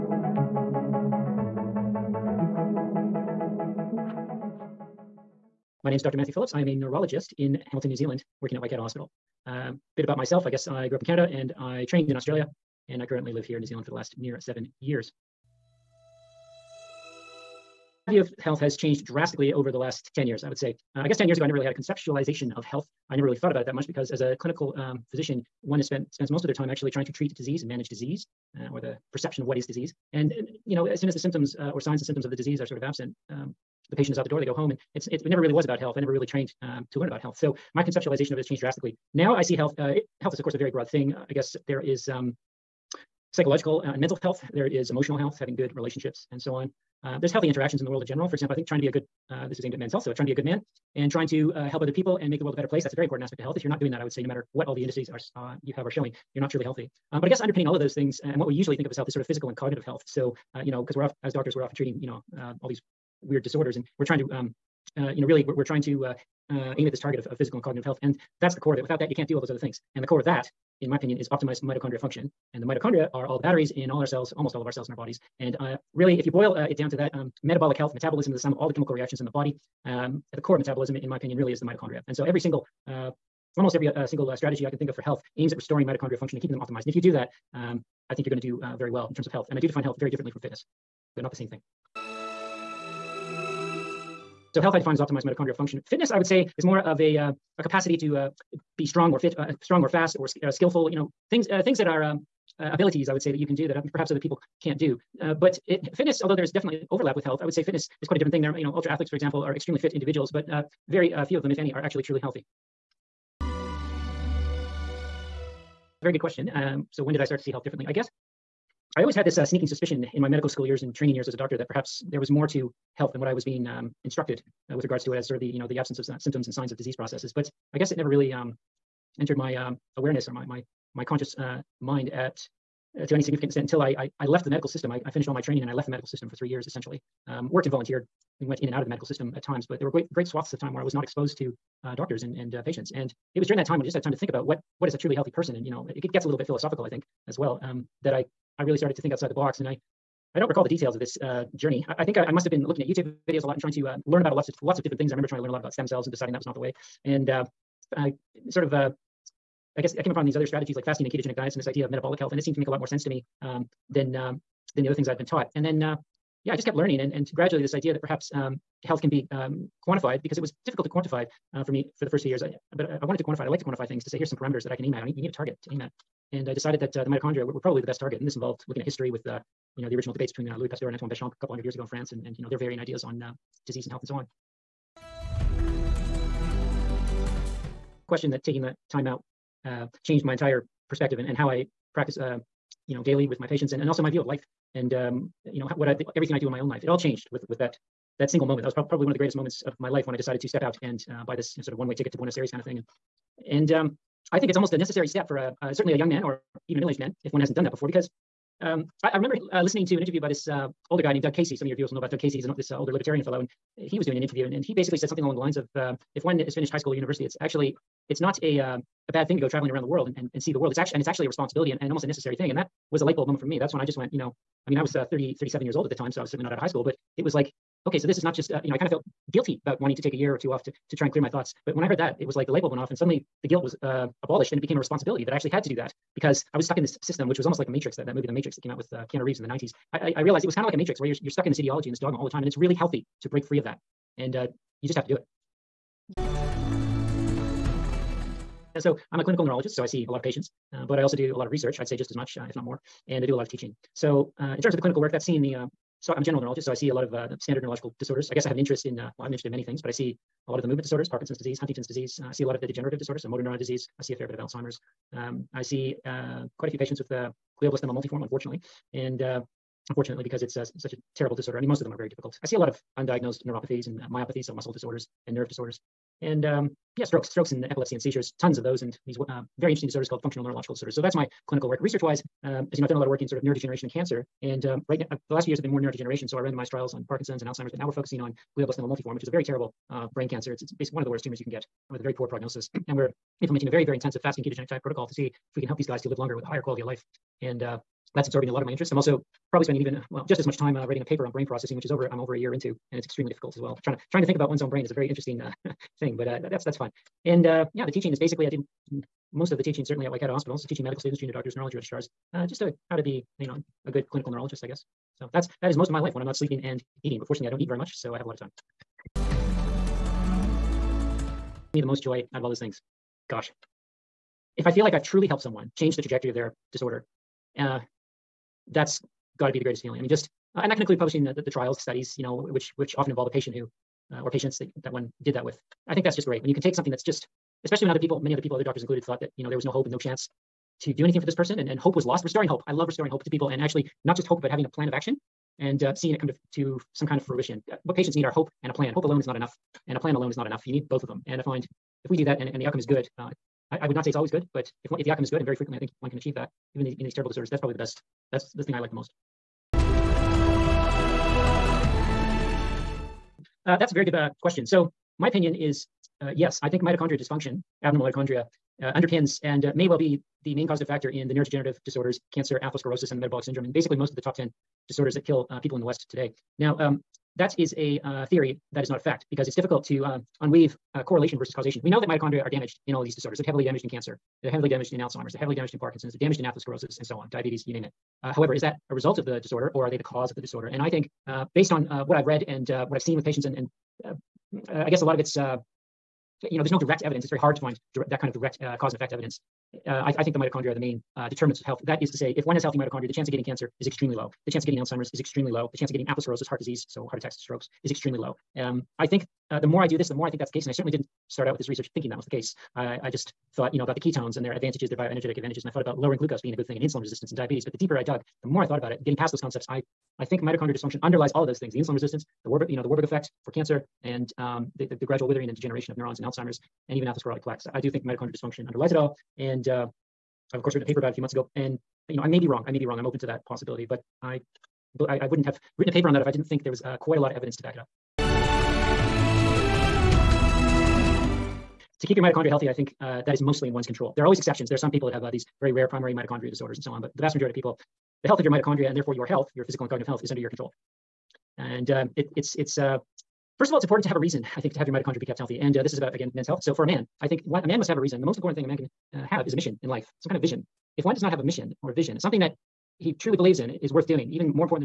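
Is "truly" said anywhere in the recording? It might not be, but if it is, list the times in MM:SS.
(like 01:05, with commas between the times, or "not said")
00:56, 01:52, 02:24, 05:25, 07:43.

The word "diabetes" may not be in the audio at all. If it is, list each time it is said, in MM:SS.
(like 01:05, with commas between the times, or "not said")
06:27, 06:57.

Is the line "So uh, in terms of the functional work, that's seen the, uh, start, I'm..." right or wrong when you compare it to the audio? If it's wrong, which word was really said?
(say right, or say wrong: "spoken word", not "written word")
wrong: "clinical", not "functional".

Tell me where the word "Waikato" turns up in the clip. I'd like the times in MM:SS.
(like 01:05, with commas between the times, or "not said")
00:08, 05:10.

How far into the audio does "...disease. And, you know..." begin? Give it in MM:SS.
00:29.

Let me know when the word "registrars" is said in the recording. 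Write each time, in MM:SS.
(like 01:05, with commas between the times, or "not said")
05:11.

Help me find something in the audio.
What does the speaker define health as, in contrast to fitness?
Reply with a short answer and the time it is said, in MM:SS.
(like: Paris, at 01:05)
Optimized mitochondrial function, at 01:34.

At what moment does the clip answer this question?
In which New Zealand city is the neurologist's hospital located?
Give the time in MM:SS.
00:07.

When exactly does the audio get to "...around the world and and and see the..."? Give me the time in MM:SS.
03:39.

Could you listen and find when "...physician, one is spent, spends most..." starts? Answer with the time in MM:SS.
00:25.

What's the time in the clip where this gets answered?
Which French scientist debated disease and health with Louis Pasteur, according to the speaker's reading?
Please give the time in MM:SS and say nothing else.
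03:00.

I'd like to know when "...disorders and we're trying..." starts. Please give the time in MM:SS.
01:03.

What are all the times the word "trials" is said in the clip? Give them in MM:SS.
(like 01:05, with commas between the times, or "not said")
04:46, 05:31.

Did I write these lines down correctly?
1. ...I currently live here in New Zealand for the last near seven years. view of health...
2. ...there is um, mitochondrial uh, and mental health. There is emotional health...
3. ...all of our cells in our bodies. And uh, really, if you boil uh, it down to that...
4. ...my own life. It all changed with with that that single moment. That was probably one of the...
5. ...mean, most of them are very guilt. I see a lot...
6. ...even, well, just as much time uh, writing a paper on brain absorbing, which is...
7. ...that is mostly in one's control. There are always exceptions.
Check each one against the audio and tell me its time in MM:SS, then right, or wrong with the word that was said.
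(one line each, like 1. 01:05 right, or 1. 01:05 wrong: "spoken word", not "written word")
1. 00:13 right
2. 00:41 wrong: "psychological", not "mitochondrial"
3. 01:14 right
4. 03:16 right
5. 04:31 wrong: "difficult", not "guilt"
6. 04:59 wrong: "processing", not "absorbing"
7. 07:23 right.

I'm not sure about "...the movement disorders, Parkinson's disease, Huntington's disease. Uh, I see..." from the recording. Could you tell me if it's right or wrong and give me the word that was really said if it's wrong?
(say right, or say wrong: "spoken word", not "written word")
right.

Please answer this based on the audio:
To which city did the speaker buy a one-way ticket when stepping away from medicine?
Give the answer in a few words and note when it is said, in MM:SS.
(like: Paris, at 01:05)
Buenos Aires, at 03:22.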